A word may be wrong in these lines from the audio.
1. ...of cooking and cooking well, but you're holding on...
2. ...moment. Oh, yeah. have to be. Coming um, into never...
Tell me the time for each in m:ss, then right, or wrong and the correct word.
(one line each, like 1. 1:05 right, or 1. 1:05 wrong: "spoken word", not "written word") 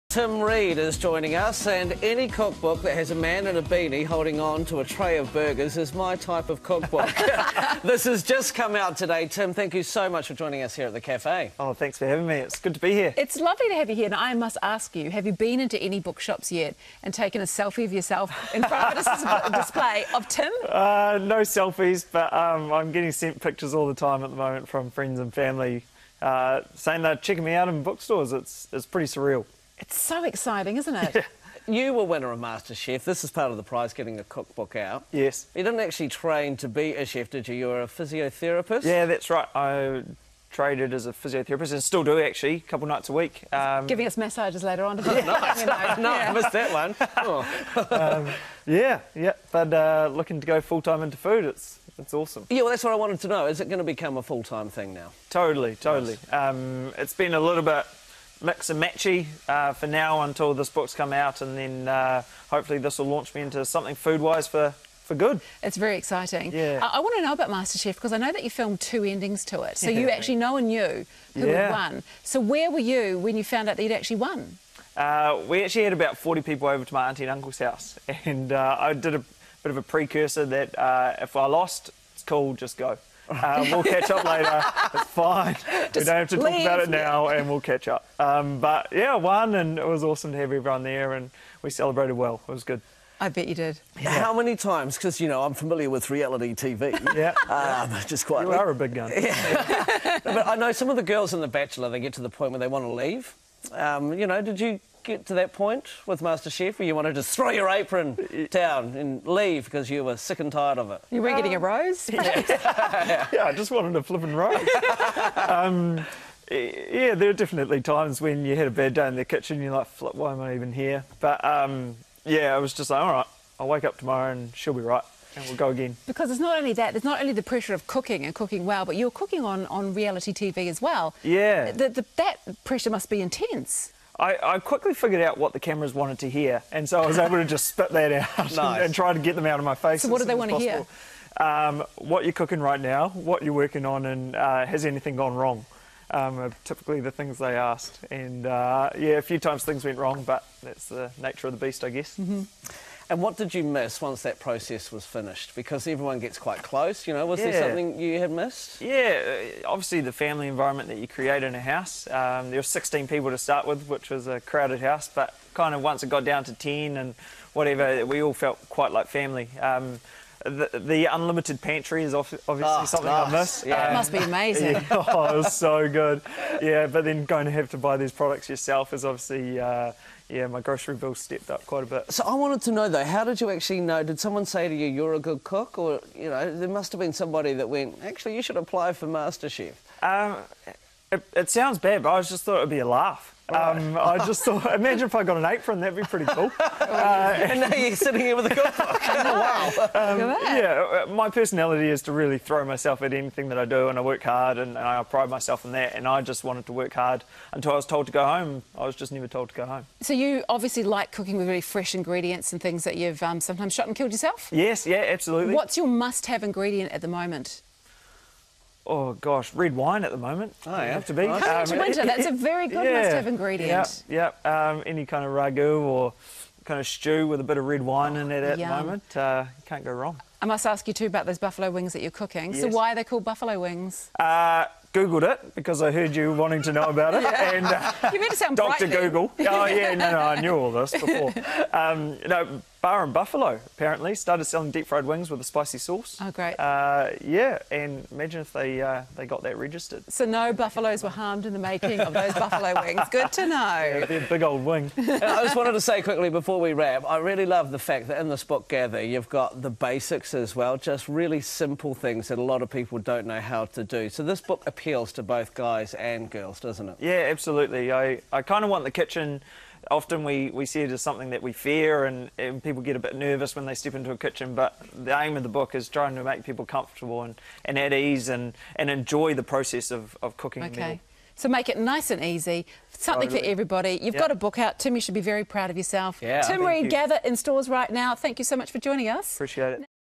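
1. 2:07 wrong: "cooking", not "holding"
2. 3:40 wrong: "winter", not "never".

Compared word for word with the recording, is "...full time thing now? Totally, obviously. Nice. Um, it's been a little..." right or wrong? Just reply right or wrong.
wrong.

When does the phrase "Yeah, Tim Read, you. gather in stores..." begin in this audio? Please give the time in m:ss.
4:46.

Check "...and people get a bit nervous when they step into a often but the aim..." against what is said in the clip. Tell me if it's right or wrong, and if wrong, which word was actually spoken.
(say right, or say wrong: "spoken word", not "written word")
wrong: "kitchen", not "often".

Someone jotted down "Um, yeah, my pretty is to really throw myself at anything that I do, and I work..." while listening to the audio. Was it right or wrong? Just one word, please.
wrong.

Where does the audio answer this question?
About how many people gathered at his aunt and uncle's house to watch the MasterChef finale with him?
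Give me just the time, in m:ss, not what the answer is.
1:16.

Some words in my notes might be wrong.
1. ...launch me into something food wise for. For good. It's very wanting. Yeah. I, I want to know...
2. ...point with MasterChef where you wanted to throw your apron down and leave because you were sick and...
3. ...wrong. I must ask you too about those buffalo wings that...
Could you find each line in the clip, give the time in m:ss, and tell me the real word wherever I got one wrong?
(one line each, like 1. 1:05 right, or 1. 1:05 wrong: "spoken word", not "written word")
1. 1:03 wrong: "exciting", not "wanting"
2. 1:45 right
3. 3:49 right.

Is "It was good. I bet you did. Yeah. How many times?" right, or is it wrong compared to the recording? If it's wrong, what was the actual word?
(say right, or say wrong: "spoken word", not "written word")
right.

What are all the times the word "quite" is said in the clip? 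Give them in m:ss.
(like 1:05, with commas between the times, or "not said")
1:38, 2:36, 2:48, 3:01.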